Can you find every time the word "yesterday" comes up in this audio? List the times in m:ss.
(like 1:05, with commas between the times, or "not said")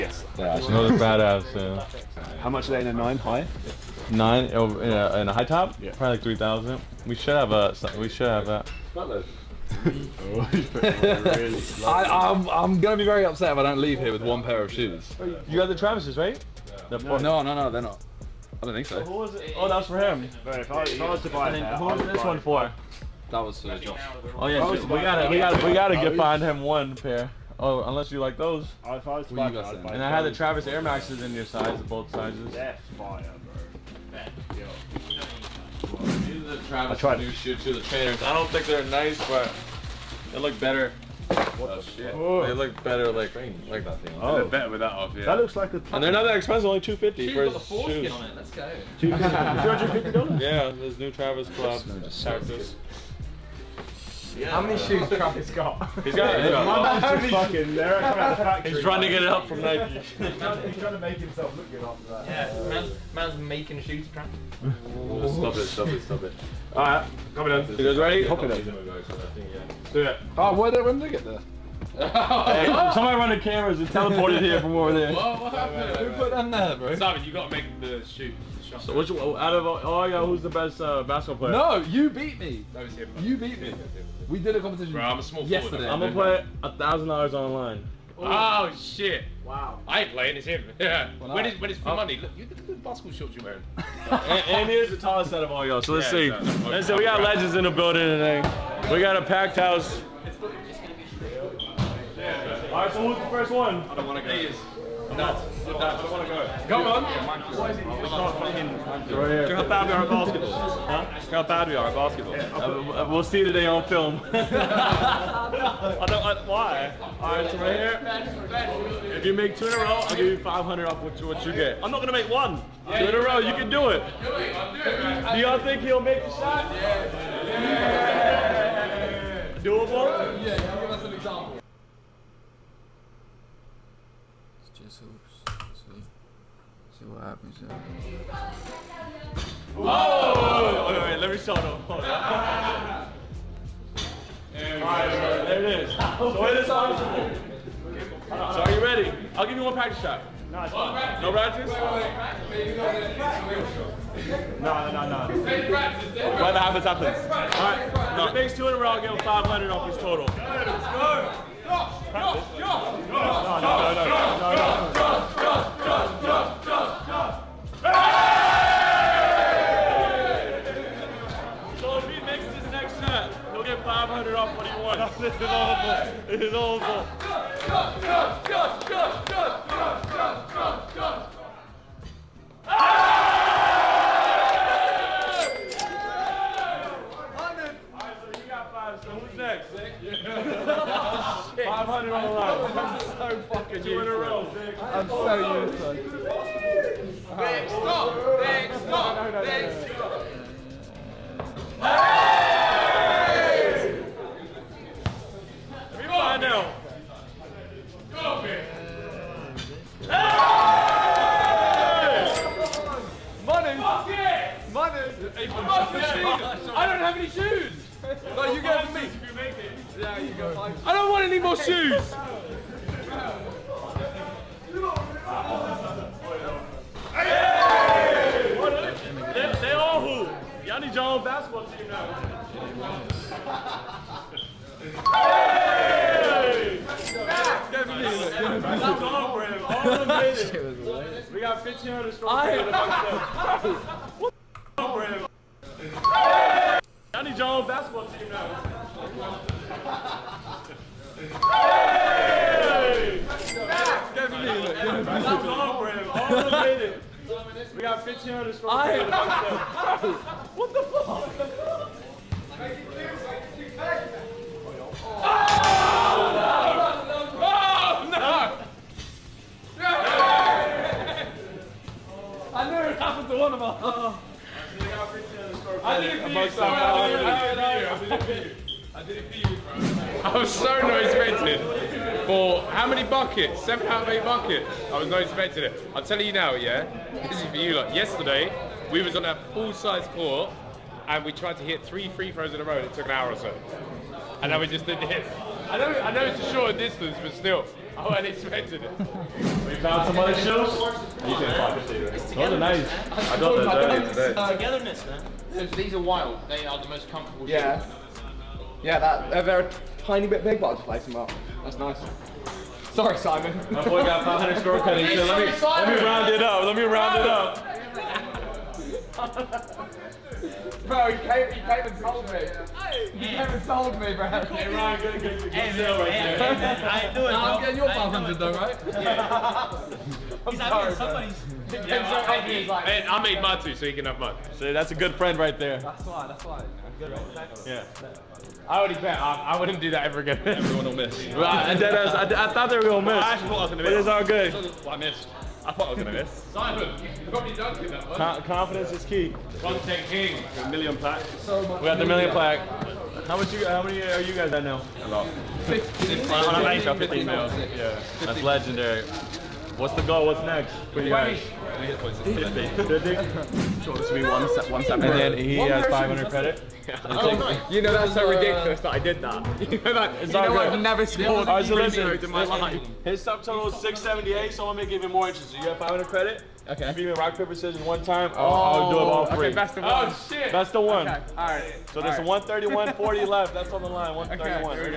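1:25, 4:47.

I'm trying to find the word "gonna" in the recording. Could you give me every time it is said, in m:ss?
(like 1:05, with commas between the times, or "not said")
0:12, 1:25, 2:02, 6:14.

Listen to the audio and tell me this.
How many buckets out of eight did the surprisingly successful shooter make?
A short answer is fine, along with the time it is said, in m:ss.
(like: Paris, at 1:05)
7, at 4:43.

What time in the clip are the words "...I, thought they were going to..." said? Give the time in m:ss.
5:41.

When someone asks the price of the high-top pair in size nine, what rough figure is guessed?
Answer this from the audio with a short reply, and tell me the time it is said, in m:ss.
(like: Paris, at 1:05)
3,000, at 0:05.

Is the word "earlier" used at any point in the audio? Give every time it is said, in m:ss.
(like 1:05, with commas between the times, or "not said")
5:03.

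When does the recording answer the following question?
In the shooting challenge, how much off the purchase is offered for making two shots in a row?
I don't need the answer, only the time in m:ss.
2:00.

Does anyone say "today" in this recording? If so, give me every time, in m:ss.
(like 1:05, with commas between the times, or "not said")
1:38, 1:53, 5:04.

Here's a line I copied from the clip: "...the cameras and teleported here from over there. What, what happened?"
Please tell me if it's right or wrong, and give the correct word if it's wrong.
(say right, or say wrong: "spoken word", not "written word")
right.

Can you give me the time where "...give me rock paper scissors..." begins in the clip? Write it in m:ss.
6:17.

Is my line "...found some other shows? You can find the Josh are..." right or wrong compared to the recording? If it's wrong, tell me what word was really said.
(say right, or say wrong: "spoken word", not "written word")
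wrong: "Those", not "Josh".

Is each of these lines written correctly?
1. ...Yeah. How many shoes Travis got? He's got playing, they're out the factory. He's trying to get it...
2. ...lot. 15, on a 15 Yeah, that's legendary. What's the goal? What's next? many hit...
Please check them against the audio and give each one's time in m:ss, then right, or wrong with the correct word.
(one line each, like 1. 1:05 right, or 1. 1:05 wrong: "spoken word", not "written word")
1. 0:54 wrong: "fucking", not "playing"
2. 5:55 right.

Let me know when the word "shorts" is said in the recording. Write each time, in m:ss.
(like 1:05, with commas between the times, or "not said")
1:33, 4:56.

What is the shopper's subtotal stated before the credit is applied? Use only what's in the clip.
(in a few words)
678.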